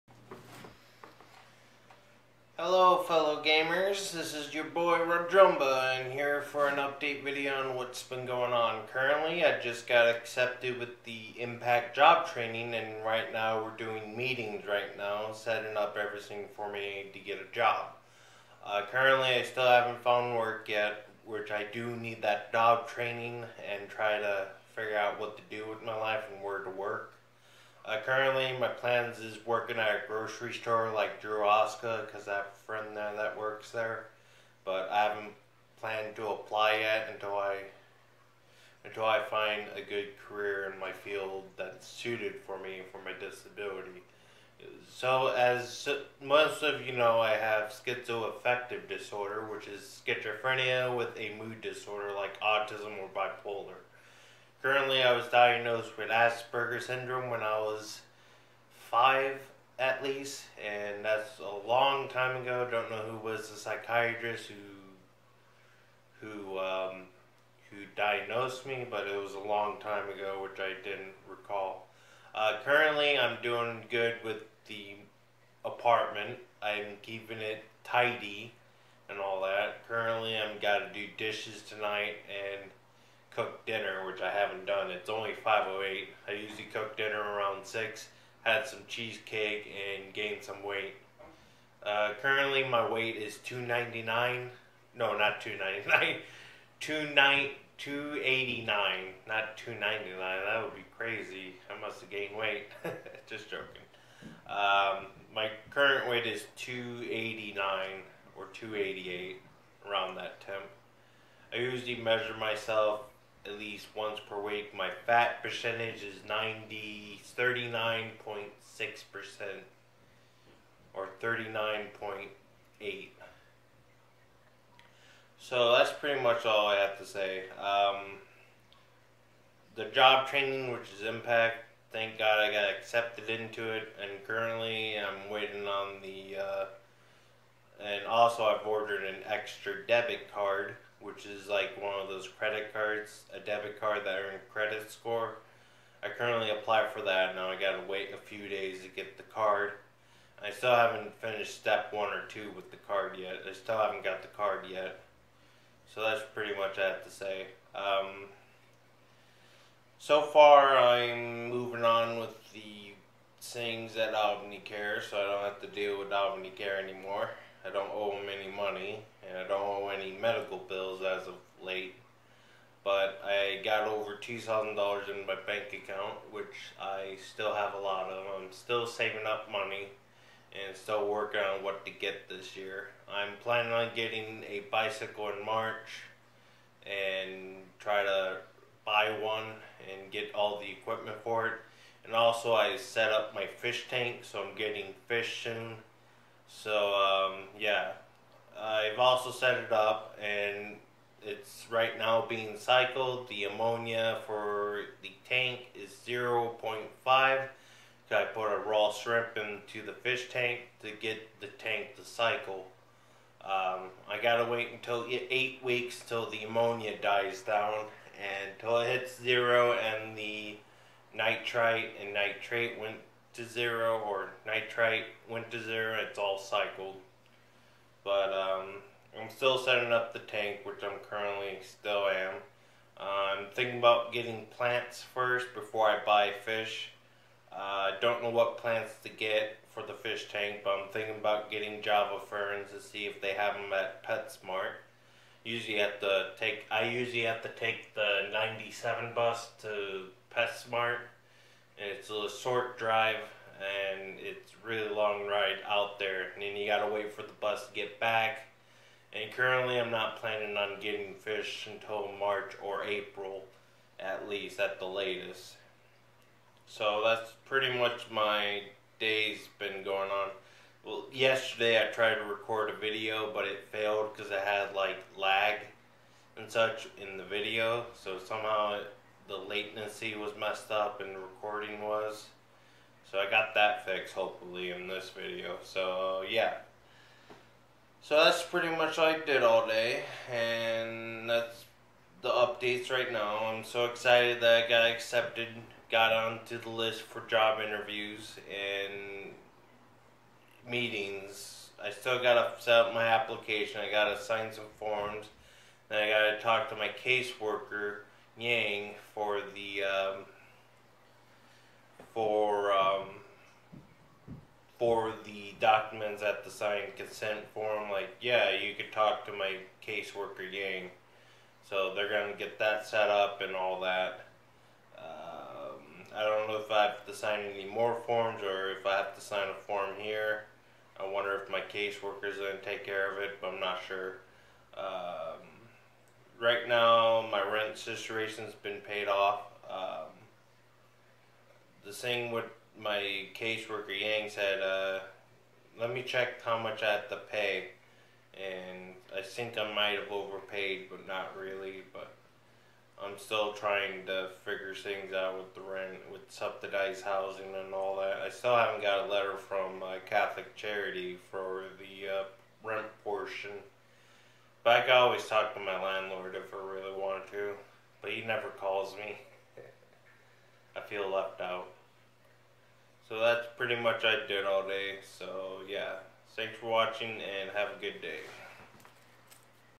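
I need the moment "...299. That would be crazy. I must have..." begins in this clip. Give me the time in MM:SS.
01:39.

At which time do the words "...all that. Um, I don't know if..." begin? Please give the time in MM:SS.
05:23.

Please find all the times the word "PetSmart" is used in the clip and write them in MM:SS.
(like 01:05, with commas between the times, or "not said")
04:04, 04:10.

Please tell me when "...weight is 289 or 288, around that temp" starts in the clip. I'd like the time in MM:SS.
01:46.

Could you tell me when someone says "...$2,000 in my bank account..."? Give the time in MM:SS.
02:54.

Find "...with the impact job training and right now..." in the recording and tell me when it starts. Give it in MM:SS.
00:10.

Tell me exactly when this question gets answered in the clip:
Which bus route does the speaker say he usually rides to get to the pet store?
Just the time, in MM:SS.
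04:08.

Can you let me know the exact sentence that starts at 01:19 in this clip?
Currently, I'm got to do dishes tonight and cook dinner, which I haven't done.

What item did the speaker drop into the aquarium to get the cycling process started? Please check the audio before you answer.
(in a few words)
Raw shrimp.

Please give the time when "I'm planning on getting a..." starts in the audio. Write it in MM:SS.
03:03.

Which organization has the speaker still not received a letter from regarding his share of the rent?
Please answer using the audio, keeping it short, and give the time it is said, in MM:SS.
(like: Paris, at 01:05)
Catholic Charity, at 06:00.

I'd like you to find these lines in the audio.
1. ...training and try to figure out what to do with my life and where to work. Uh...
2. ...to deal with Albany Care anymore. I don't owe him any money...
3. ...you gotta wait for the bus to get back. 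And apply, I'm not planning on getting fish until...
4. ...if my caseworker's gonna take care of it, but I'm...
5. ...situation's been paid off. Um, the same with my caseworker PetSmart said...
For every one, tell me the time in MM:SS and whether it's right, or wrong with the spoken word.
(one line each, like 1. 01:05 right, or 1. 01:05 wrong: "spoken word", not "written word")
1. 00:22 right
2. 02:45 right
3. 04:16 wrong: "currently", not "apply"
4. 05:31 right
5. 05:37 wrong: "Yang", not "PetSmart".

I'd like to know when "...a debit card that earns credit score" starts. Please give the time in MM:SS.
02:23.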